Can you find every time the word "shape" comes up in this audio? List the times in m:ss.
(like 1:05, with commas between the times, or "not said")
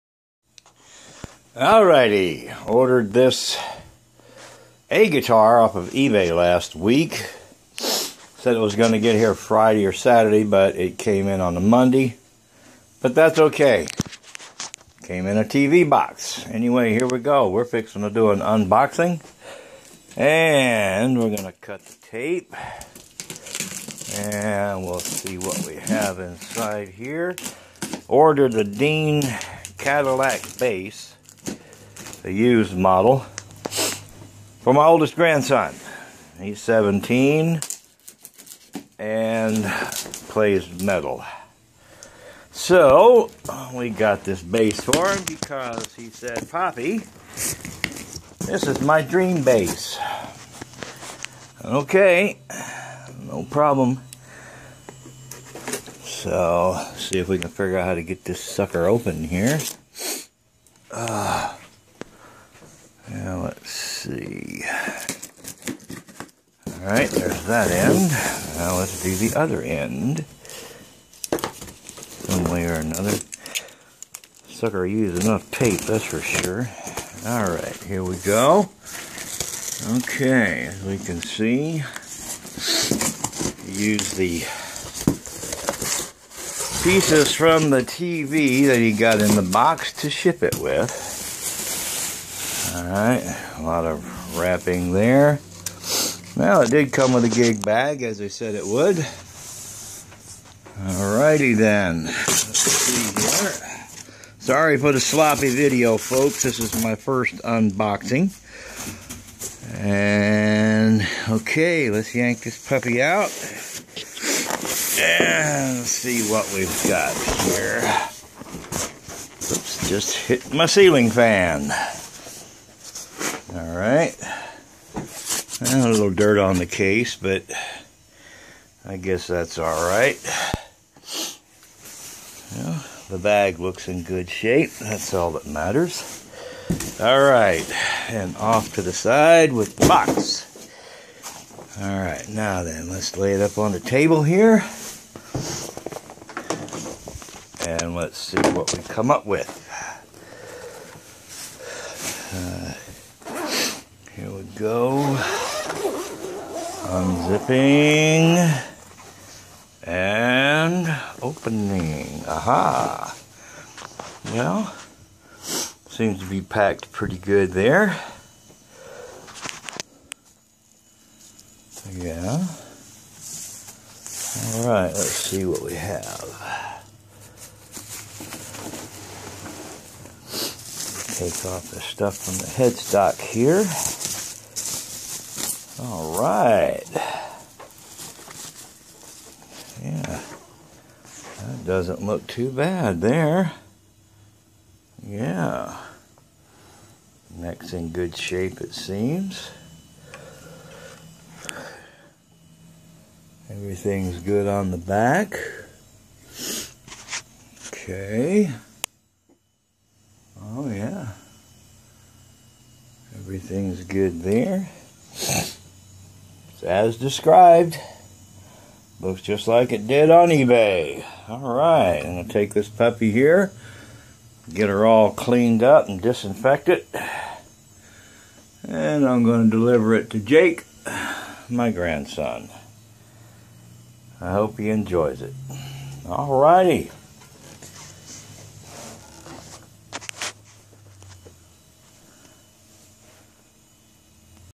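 2:14, 3:18.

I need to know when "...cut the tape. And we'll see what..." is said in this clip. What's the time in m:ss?
0:21.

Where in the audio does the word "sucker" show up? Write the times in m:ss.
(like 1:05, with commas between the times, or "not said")
0:58, 1:14.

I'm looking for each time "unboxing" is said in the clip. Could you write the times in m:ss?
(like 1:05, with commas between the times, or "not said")
0:18, 1:47.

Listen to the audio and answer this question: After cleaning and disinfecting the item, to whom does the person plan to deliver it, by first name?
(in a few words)
Jake.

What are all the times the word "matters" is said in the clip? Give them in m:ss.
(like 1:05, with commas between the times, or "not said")
2:15.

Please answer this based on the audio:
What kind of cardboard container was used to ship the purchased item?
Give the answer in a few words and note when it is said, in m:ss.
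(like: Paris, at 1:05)
TV box, at 0:15.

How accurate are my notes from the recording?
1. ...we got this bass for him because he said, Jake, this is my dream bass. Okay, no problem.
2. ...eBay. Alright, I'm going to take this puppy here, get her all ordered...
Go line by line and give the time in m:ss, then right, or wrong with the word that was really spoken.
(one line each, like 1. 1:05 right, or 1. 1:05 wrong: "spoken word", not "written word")
1. 0:43 wrong: "Poppy", not "Jake"
2. 3:40 wrong: "cleaned", not "ordered".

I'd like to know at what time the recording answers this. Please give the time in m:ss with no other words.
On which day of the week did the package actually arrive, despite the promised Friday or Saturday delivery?
0:11.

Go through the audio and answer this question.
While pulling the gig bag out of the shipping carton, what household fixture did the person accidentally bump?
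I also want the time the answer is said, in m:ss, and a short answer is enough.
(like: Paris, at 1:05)
Ceiling fan, at 2:00.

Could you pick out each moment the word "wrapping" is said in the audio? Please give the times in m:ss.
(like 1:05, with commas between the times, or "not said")
1:34.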